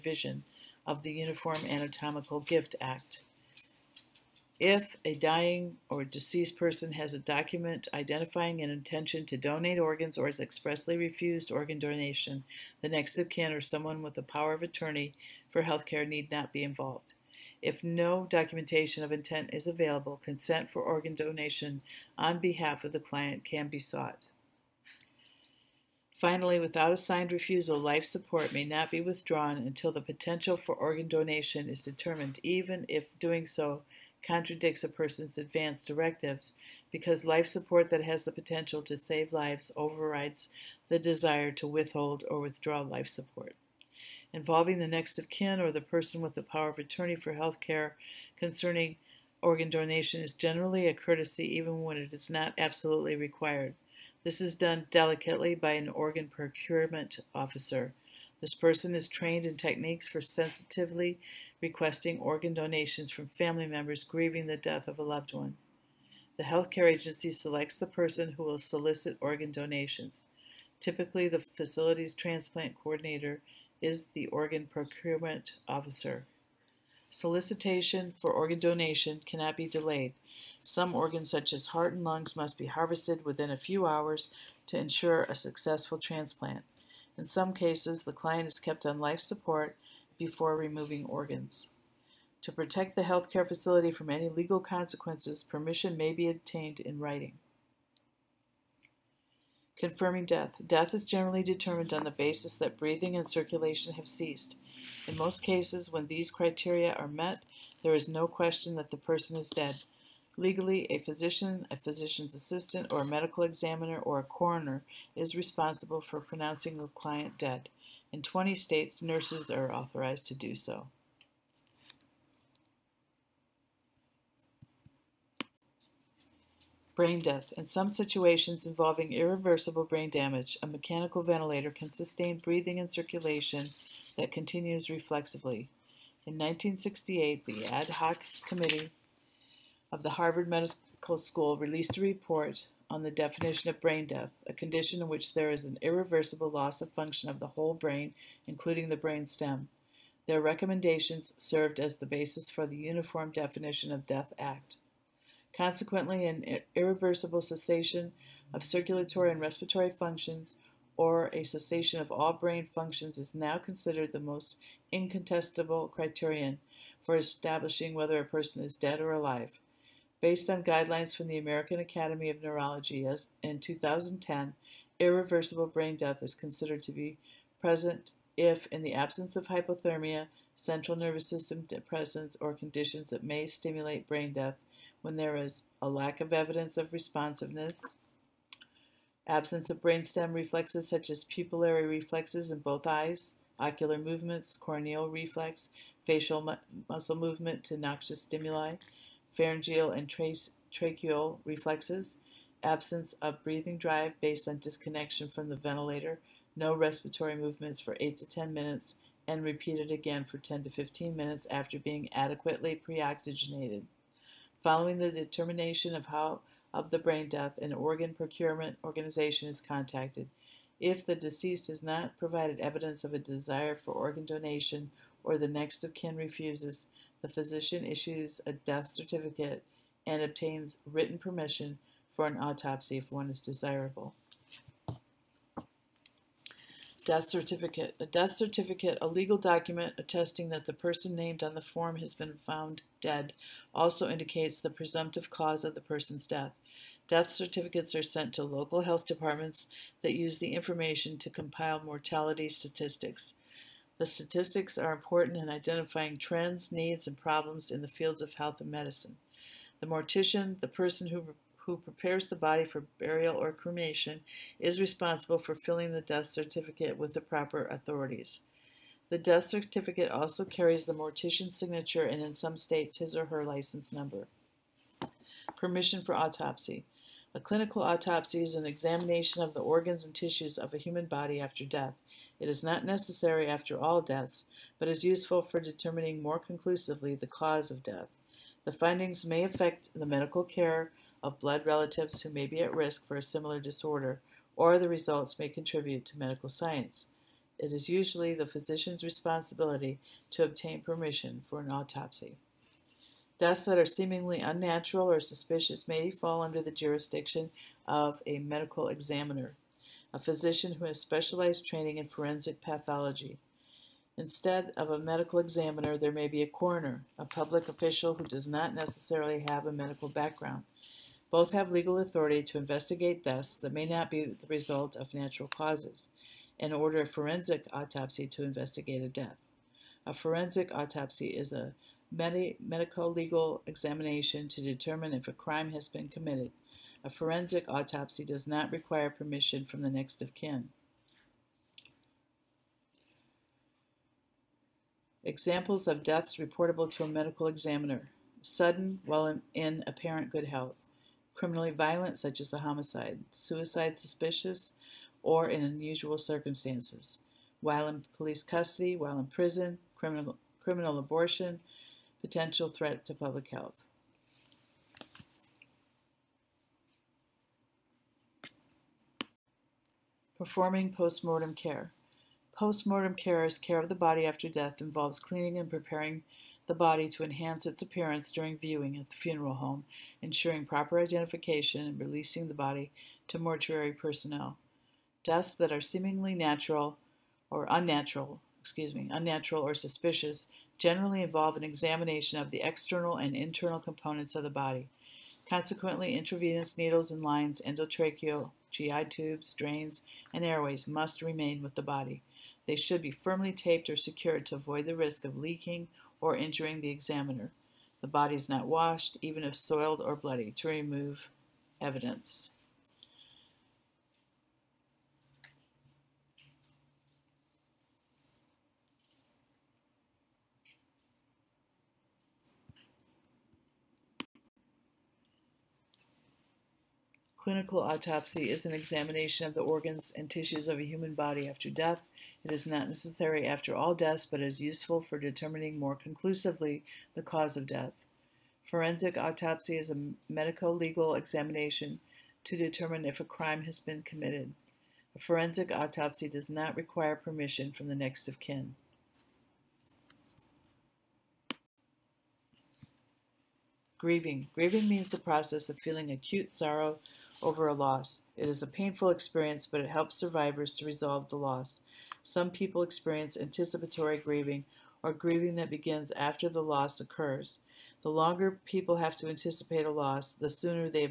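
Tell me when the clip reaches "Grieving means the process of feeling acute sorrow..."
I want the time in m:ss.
7:34.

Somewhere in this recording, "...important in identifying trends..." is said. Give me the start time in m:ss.
4:14.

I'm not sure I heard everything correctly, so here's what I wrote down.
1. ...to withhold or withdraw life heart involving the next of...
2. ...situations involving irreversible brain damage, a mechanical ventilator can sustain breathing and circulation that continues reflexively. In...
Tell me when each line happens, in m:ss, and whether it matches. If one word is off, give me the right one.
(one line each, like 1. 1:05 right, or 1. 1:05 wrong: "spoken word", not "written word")
1. 0:41 wrong: "support", not "heart"
2. 2:07 right.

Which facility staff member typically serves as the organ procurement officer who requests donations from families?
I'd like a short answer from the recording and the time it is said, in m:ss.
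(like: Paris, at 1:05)
Transplant coordinator, at 1:12.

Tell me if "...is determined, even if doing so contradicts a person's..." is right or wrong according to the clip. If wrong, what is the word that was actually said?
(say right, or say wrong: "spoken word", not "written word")
right.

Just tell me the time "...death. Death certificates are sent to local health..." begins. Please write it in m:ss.
4:06.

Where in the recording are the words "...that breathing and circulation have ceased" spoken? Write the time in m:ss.
1:42.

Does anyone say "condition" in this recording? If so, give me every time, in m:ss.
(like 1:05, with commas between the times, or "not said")
2:24, 3:02.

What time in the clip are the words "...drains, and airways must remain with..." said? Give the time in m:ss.
6:39.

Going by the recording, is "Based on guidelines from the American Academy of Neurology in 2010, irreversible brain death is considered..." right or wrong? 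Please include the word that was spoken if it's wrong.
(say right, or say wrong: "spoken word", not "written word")
right.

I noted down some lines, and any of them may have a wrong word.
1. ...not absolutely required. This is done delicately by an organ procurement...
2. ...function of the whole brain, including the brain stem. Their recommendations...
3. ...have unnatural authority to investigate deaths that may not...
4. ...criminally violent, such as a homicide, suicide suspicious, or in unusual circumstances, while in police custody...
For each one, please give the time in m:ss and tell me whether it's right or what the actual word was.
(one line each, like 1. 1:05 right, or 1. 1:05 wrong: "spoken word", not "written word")
1. 0:52 right
2. 2:26 right
3. 5:21 wrong: "legal", not "unnatural"
4. 5:51 right.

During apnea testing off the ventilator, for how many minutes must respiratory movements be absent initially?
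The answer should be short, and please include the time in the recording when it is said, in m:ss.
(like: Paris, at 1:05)
8 to 10 minutes, at 3:27.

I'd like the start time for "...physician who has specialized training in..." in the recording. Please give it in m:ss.
5:10.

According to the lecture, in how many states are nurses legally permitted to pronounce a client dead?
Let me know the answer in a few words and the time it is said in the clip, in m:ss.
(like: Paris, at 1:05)
20, at 1:58.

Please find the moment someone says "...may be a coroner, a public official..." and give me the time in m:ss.
5:16.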